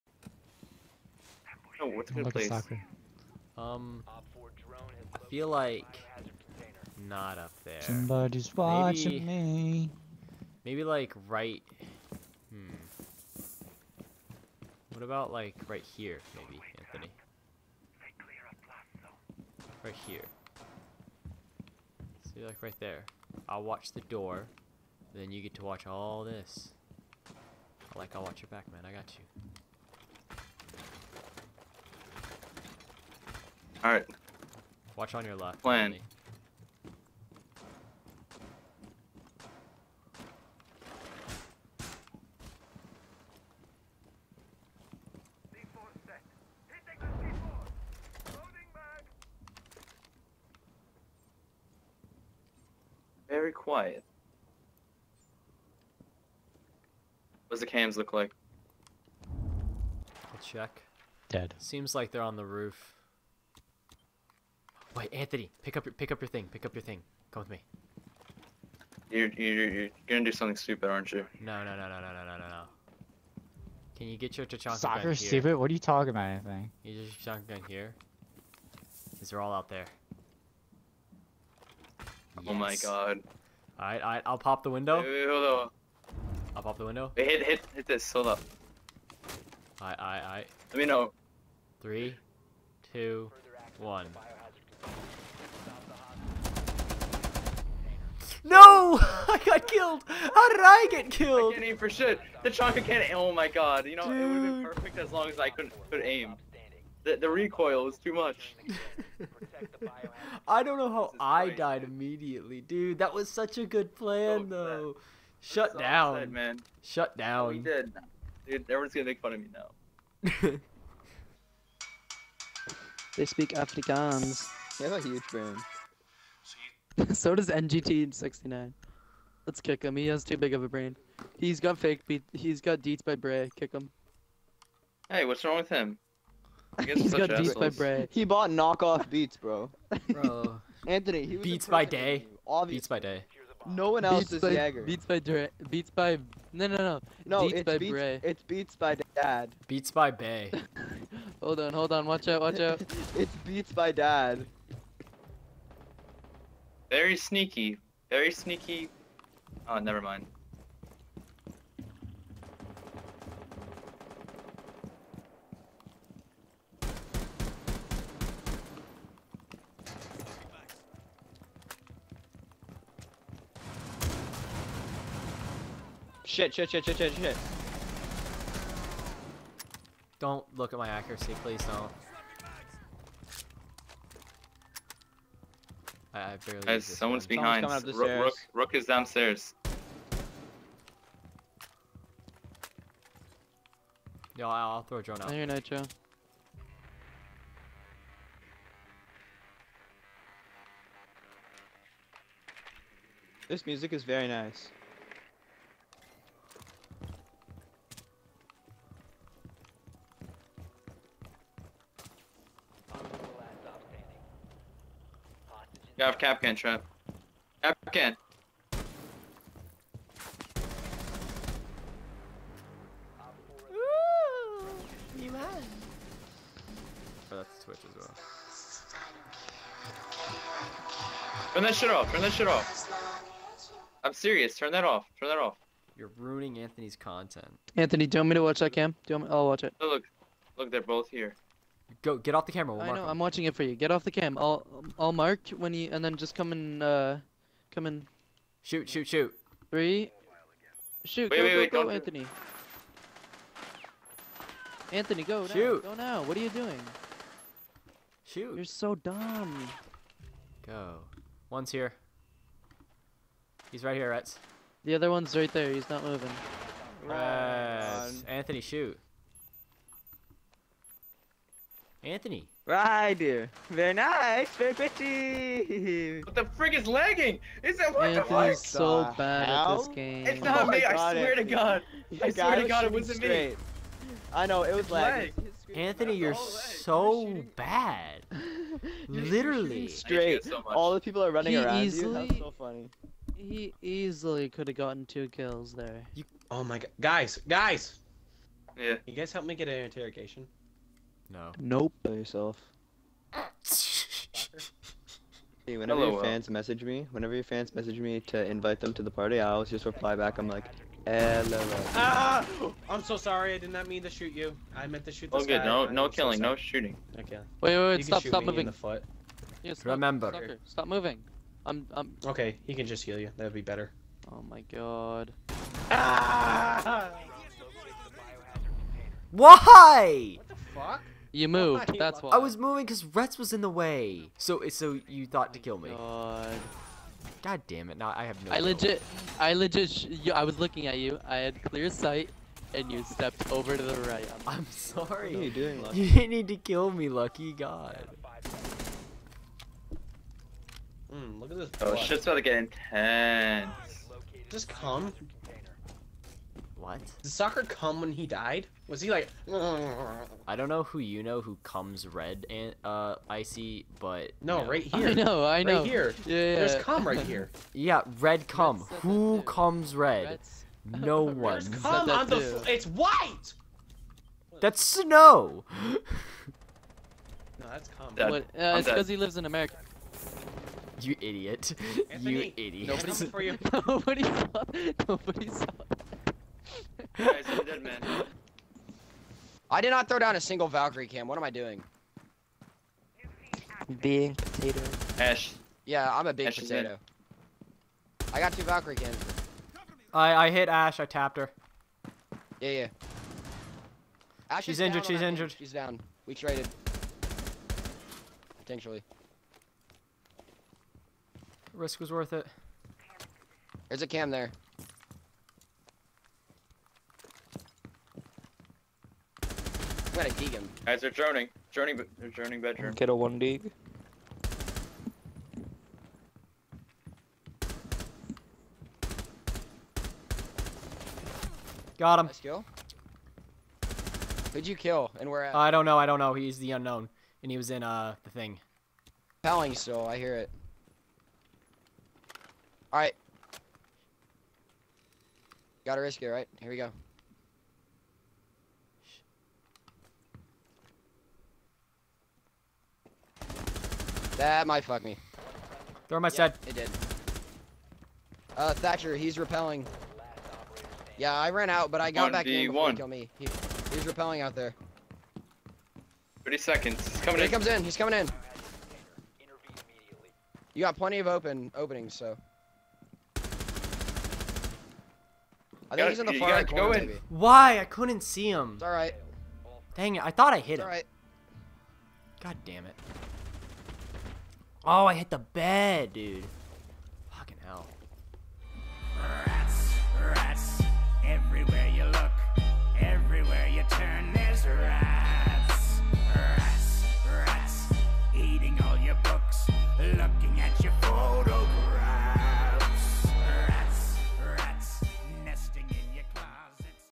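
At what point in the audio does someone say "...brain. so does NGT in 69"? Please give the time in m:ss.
2:05.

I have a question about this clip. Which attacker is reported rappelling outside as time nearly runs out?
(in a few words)
Thatcher.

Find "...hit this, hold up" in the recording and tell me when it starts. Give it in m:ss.
1:27.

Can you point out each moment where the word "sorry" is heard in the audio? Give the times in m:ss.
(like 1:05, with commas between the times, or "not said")
5:13, 5:44.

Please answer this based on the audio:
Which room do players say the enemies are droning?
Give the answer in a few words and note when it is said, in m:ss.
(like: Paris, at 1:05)
Bedroom, at 7:02.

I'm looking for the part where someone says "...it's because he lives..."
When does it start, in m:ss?
6:18.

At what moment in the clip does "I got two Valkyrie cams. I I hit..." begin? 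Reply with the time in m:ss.
6:38.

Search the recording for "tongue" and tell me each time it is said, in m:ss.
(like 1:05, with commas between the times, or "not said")
not said.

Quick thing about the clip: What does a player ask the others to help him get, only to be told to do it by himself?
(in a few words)
An interrogation.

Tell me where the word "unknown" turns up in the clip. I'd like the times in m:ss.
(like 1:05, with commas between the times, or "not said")
7:16.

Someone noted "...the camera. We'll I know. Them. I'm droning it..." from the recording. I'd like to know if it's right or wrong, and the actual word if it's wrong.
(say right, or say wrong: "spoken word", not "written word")
wrong: "watching", not "droning".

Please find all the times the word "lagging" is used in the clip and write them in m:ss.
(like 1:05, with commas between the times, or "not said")
4:36, 4:44.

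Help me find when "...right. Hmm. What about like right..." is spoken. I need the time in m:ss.
0:11.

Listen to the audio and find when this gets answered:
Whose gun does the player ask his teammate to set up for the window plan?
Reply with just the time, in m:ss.
1:14.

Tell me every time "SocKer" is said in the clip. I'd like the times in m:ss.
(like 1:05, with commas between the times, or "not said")
1:14, 5:57.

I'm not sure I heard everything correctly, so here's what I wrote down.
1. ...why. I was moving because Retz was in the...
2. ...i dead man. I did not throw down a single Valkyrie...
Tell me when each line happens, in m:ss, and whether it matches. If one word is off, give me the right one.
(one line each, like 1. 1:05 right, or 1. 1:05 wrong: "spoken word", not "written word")
1. 5:32 right
2. 6:27 right.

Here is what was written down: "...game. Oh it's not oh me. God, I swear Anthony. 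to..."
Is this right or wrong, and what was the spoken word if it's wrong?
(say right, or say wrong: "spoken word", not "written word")
right.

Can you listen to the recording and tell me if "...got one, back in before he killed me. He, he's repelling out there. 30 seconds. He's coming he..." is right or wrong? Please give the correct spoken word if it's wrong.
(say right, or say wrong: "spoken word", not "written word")
right.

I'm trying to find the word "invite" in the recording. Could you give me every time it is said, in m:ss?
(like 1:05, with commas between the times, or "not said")
5:08.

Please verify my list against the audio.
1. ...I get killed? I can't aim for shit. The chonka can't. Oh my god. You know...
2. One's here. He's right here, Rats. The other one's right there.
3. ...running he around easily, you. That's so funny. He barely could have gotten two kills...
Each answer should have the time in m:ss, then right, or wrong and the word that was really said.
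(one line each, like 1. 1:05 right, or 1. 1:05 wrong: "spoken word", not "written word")
1. 1:40 right
2. 4:21 right
3. 4:51 wrong: "easily", not "barely".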